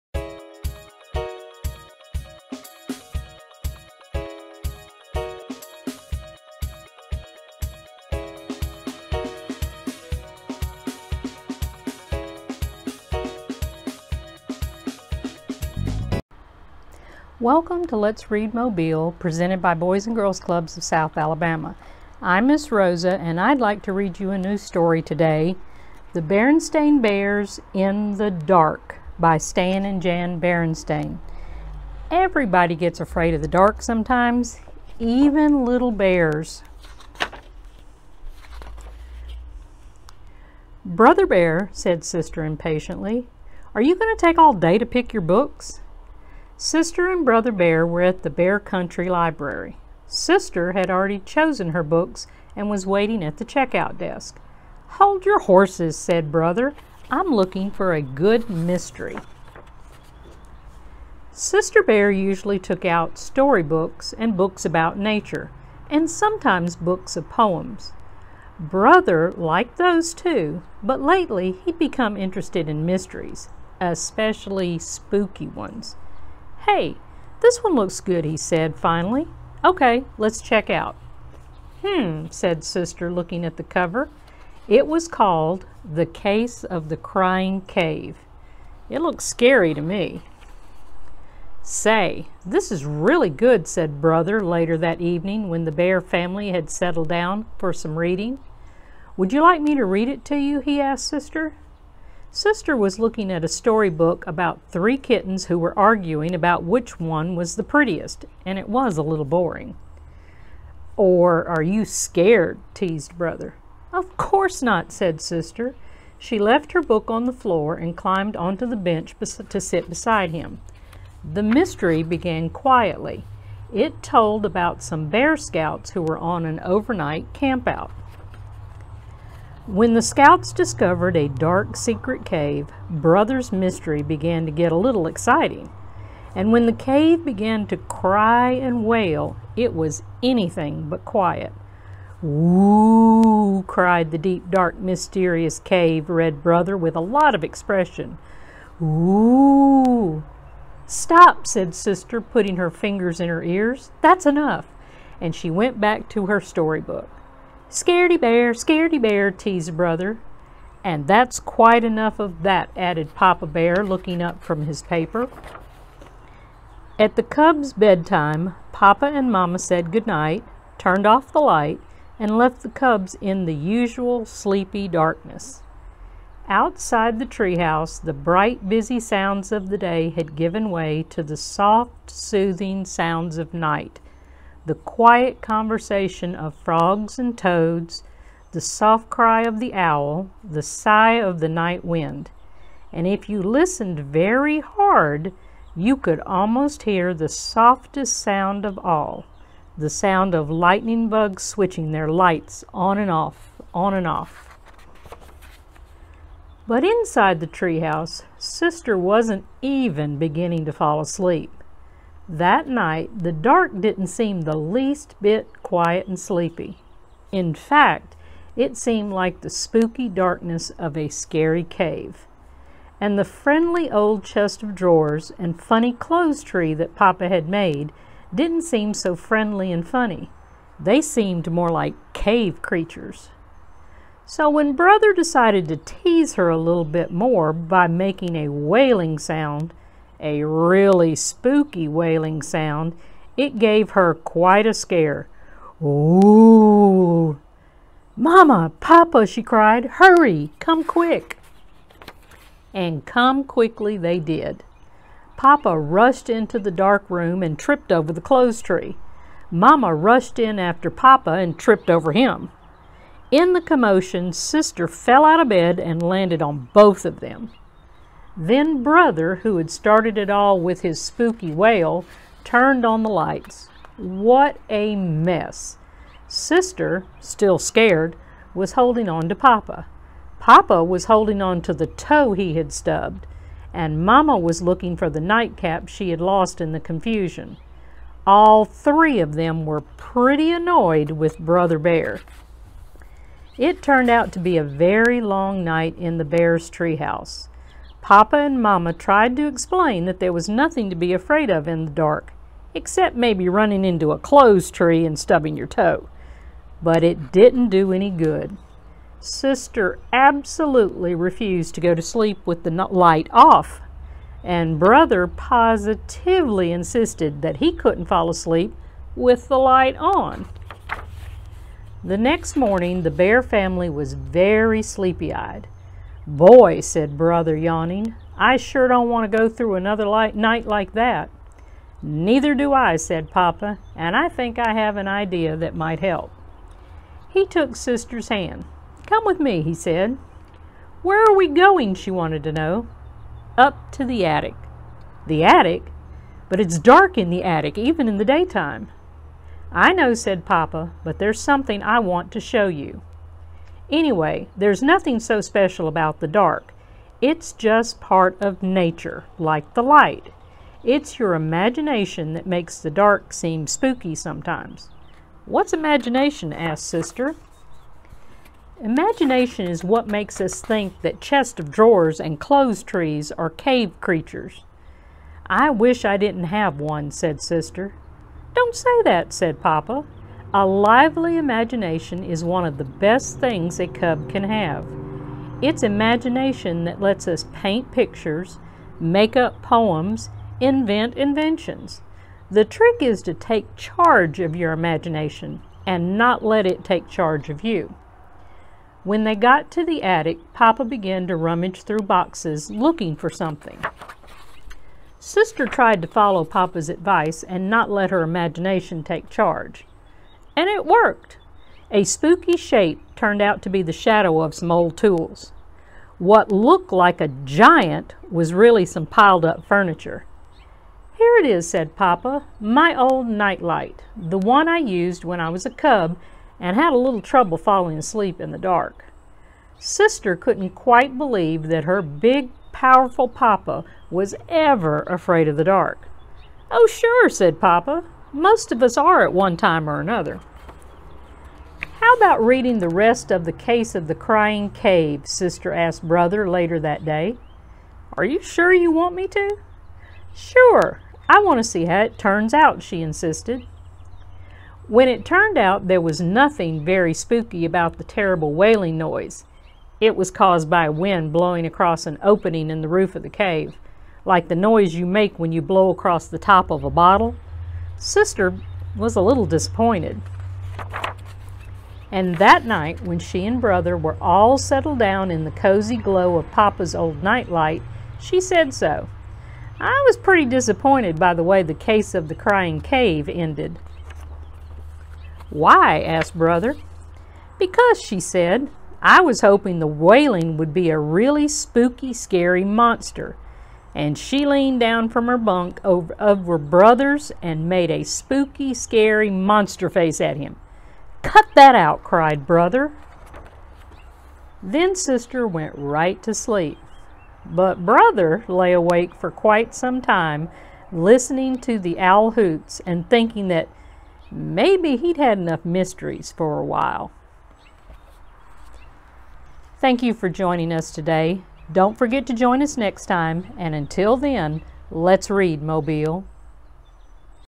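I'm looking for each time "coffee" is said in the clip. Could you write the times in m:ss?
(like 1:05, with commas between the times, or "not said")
not said.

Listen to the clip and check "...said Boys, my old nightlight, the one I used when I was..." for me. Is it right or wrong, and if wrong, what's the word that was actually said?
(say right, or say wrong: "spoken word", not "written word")
wrong: "Papa", not "Boys".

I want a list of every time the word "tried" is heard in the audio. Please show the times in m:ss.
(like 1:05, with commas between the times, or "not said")
4:58, 6:45.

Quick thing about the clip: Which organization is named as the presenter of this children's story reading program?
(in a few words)
Boys and Girls Clubs of South Alabama.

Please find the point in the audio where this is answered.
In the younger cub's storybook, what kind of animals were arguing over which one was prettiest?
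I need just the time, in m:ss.
1:44.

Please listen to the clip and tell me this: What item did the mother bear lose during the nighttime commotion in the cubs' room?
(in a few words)
nightcap.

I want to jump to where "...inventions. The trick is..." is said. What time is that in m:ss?
6:31.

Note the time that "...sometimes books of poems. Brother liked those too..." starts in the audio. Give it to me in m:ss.
1:06.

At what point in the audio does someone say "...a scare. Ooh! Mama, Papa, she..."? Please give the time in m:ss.
4:04.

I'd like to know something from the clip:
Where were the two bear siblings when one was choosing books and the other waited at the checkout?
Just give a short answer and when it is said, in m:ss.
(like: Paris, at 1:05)
Bear Country Library, at 0:48.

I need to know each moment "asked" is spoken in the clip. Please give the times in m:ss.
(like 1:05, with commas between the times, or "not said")
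1:40, 6:06, 7:25, 8:06.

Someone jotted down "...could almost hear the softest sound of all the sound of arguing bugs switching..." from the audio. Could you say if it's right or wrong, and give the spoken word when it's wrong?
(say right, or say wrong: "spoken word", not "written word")
wrong: "lightning", not "arguing".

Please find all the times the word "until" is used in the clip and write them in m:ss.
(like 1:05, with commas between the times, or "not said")
8:43.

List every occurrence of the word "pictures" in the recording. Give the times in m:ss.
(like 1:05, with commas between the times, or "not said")
6:27.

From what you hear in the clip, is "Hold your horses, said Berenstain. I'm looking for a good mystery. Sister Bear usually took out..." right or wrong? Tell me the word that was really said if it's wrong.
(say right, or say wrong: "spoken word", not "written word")
wrong: "Brother", not "Berenstain".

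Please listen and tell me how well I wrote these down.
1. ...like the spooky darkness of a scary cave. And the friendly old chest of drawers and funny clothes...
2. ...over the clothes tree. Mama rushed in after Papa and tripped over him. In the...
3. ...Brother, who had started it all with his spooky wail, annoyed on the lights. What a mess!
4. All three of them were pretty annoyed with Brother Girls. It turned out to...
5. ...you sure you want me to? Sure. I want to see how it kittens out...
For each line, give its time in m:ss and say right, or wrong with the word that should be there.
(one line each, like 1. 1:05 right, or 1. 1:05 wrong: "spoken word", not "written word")
1. 3:39 right
2. 4:17 right
3. 4:28 wrong: "turned", not "annoyed"
4. 4:48 wrong: "Bear", not "Girls"
5. 7:28 wrong: "turns", not "kittens".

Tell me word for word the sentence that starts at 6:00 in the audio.
It's your imagination that makes the dark seem spooky sometimes.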